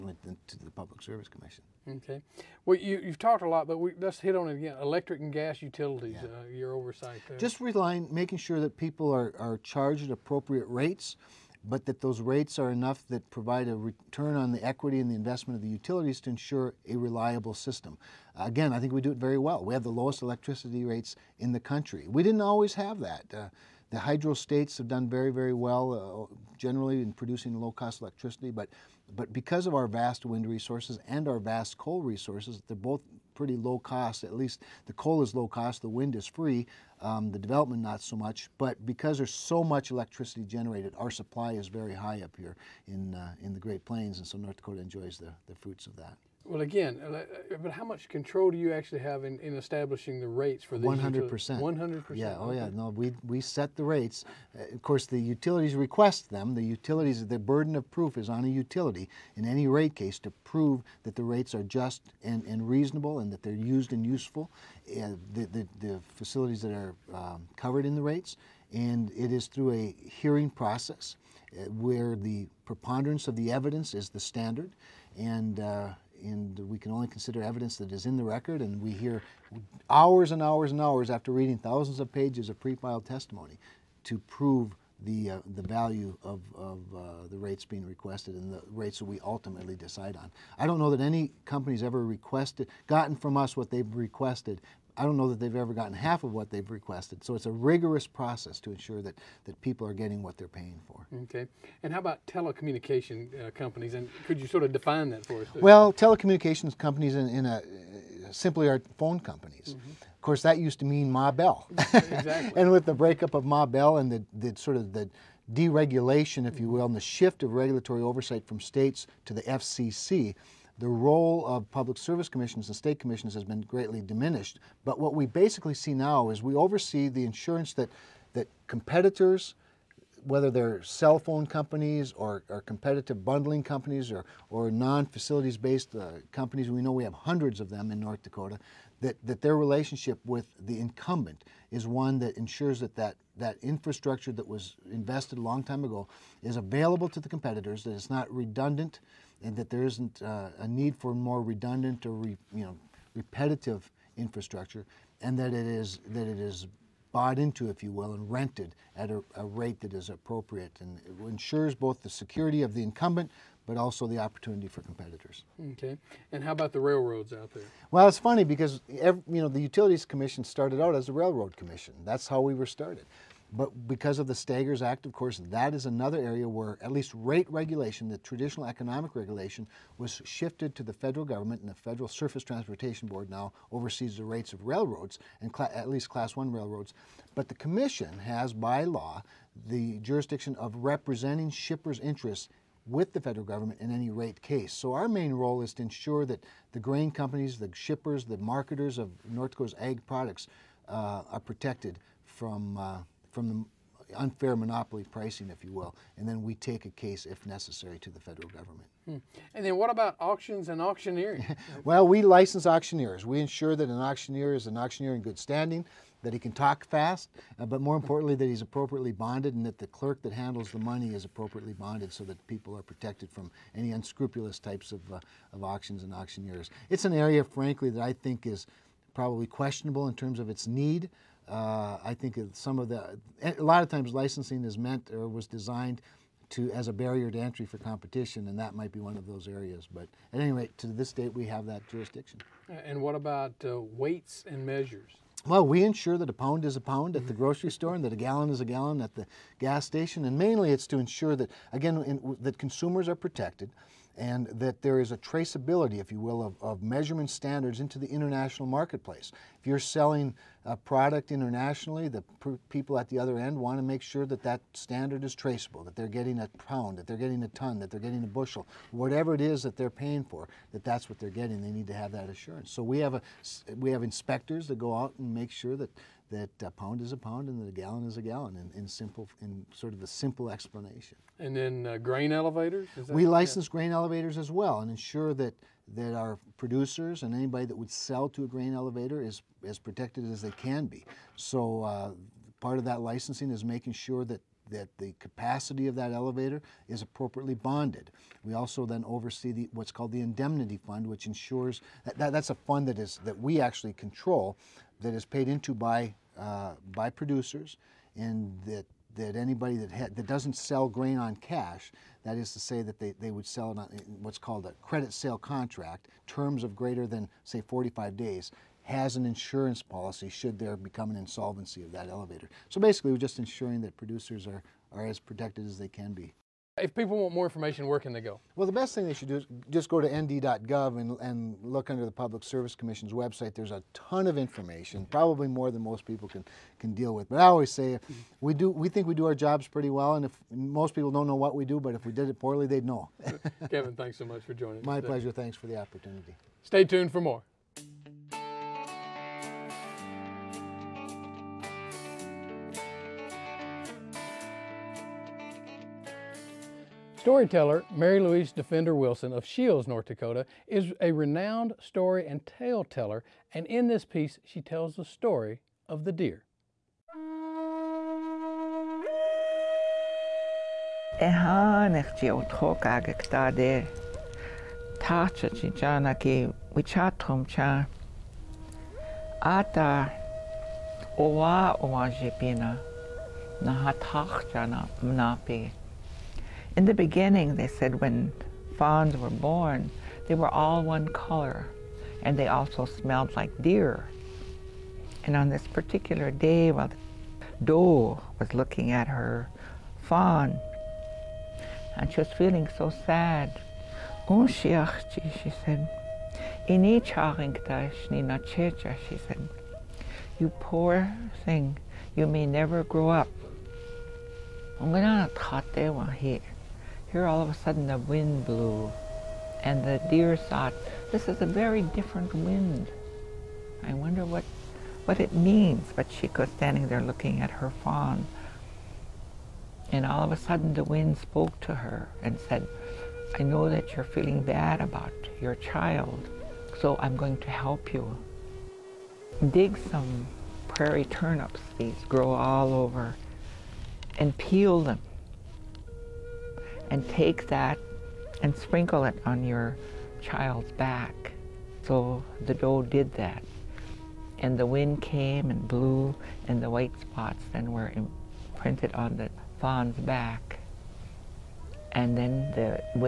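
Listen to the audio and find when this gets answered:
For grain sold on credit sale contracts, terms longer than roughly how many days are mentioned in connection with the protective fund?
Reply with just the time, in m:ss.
5:17.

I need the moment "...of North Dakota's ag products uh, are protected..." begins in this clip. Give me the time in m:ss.
3:18.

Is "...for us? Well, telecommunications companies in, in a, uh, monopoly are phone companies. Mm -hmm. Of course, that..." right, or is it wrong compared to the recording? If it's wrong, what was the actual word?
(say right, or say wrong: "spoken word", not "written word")
wrong: "simply", not "monopoly".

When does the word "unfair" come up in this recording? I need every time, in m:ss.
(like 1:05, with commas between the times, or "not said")
3:24.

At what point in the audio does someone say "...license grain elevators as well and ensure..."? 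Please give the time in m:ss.
4:43.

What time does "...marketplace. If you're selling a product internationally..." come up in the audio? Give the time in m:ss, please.
4:18.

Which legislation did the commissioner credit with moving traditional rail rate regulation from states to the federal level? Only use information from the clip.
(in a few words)
Staggers Act.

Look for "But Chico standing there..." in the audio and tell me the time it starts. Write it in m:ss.
7:05.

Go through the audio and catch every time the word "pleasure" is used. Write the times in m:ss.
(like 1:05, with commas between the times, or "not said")
5:45.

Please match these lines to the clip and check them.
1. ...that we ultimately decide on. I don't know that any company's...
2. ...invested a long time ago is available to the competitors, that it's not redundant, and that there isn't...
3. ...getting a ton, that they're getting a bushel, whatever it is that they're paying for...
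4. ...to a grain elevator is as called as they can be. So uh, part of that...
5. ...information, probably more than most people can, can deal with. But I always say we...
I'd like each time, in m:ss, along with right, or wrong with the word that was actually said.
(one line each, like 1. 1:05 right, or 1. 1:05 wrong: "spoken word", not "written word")
1. 1:28 right
2. 2:24 right
3. 4:27 right
4. 4:48 wrong: "protected", not "called"
5. 5:34 right.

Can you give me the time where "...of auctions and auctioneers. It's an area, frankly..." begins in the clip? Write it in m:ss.
3:45.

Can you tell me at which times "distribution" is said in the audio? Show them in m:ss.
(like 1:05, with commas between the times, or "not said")
not said.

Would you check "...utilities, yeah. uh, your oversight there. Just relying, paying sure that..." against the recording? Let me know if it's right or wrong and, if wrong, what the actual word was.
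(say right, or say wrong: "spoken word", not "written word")
wrong: "making", not "paying".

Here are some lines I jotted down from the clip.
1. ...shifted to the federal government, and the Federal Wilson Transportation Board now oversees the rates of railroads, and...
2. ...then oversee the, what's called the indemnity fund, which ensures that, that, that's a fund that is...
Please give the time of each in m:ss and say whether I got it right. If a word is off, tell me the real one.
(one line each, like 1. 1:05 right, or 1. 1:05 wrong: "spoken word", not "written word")
1. 3:00 wrong: "Surface", not "Wilson"
2. 4:58 right.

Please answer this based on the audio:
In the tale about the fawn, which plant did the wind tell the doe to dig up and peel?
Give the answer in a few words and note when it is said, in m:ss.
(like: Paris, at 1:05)
prairie turnips, at 7:20.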